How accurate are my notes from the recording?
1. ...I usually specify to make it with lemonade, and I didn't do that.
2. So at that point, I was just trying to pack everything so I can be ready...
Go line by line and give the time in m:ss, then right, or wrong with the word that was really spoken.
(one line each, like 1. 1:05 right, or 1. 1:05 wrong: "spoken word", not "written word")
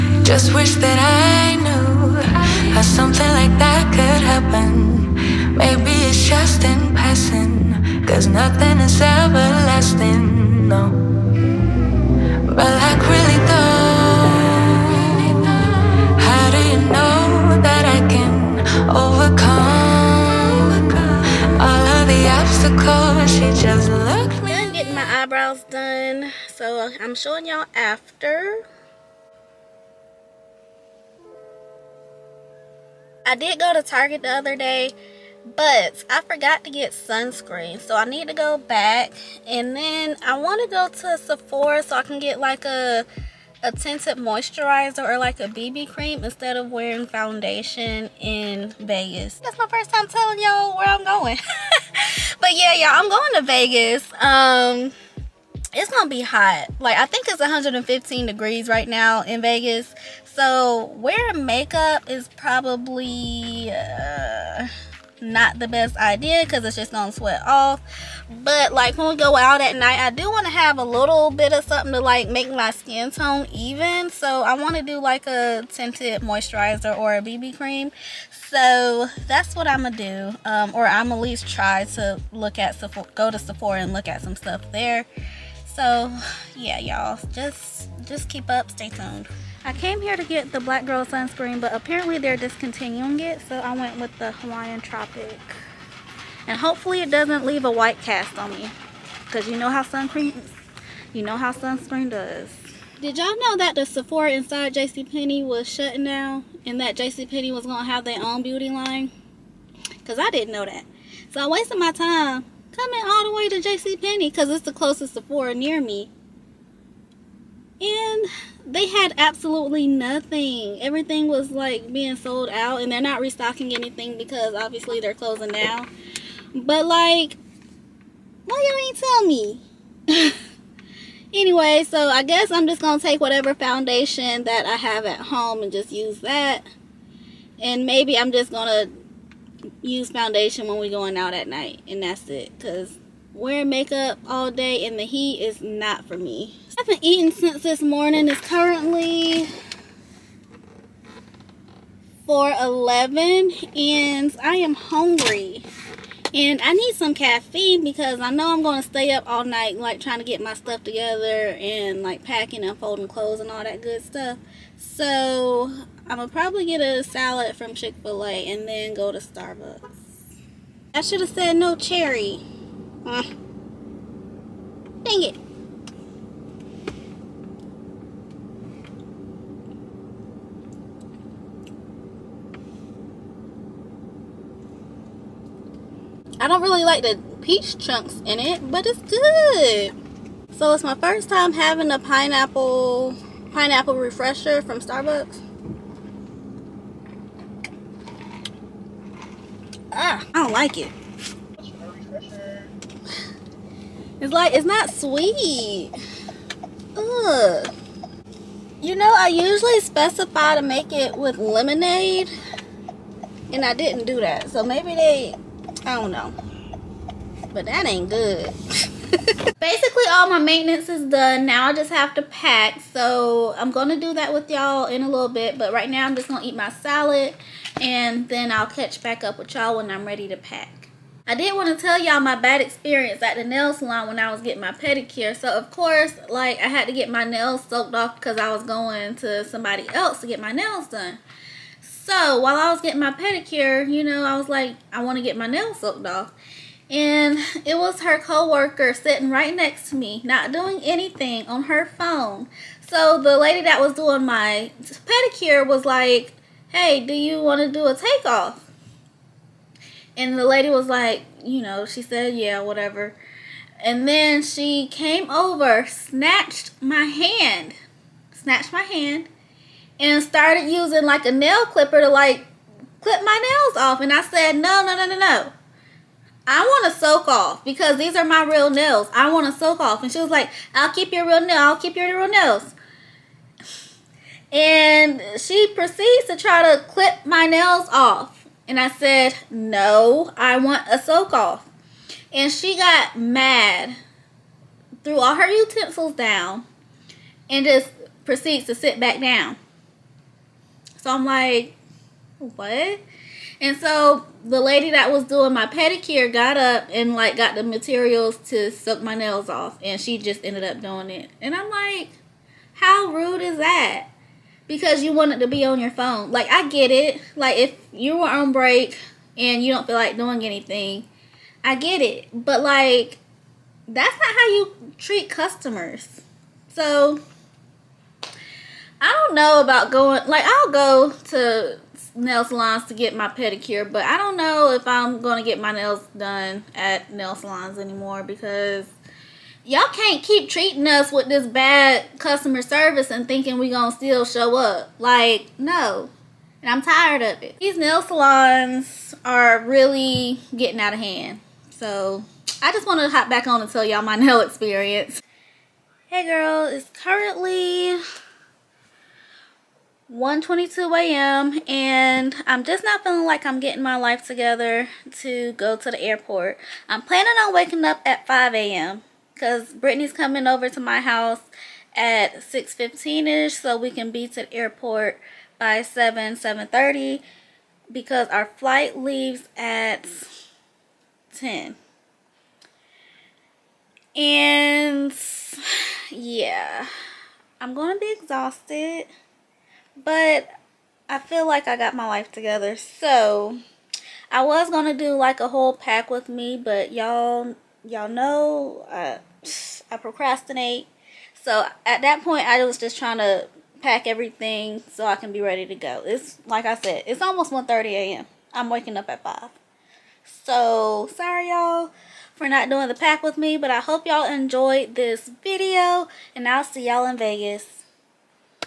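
1. 3:29 right
2. 6:41 right.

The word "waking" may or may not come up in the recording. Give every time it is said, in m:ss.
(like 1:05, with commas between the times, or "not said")
6:07, 6:48.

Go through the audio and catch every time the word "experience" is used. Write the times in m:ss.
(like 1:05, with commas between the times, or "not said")
3:52, 5:54.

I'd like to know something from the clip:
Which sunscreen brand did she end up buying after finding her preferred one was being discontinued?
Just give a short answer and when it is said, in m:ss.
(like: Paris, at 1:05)
Hawaiian Tropic, at 1:34.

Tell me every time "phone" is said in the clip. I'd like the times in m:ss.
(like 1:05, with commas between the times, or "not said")
4:11, 5:15.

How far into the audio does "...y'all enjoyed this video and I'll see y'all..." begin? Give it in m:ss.
6:54.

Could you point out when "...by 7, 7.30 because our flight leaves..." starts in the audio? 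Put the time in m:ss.
6:15.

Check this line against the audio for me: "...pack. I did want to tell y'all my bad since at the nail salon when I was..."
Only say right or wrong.
wrong.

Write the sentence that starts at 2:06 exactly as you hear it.
But like, why y'all ain't tell me?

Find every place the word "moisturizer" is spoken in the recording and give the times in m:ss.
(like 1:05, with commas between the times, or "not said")
0:44, 1:16.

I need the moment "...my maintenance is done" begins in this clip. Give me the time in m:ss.
3:40.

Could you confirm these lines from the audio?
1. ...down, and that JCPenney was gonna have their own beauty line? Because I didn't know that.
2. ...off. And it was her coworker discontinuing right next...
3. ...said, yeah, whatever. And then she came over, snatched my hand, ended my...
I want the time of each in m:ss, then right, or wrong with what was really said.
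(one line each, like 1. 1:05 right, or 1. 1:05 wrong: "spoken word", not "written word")
1. 1:46 right
2. 4:06 wrong: "sitting", not "discontinuing"
3. 4:22 wrong: "snatched", not "ended".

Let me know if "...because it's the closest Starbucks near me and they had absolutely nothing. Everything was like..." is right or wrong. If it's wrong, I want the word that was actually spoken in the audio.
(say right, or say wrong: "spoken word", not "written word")
wrong: "Sephora", not "Starbucks".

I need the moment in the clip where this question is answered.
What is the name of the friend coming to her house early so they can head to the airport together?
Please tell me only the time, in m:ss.
6:09.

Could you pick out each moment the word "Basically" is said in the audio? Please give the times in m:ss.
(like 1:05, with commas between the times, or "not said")
3:39.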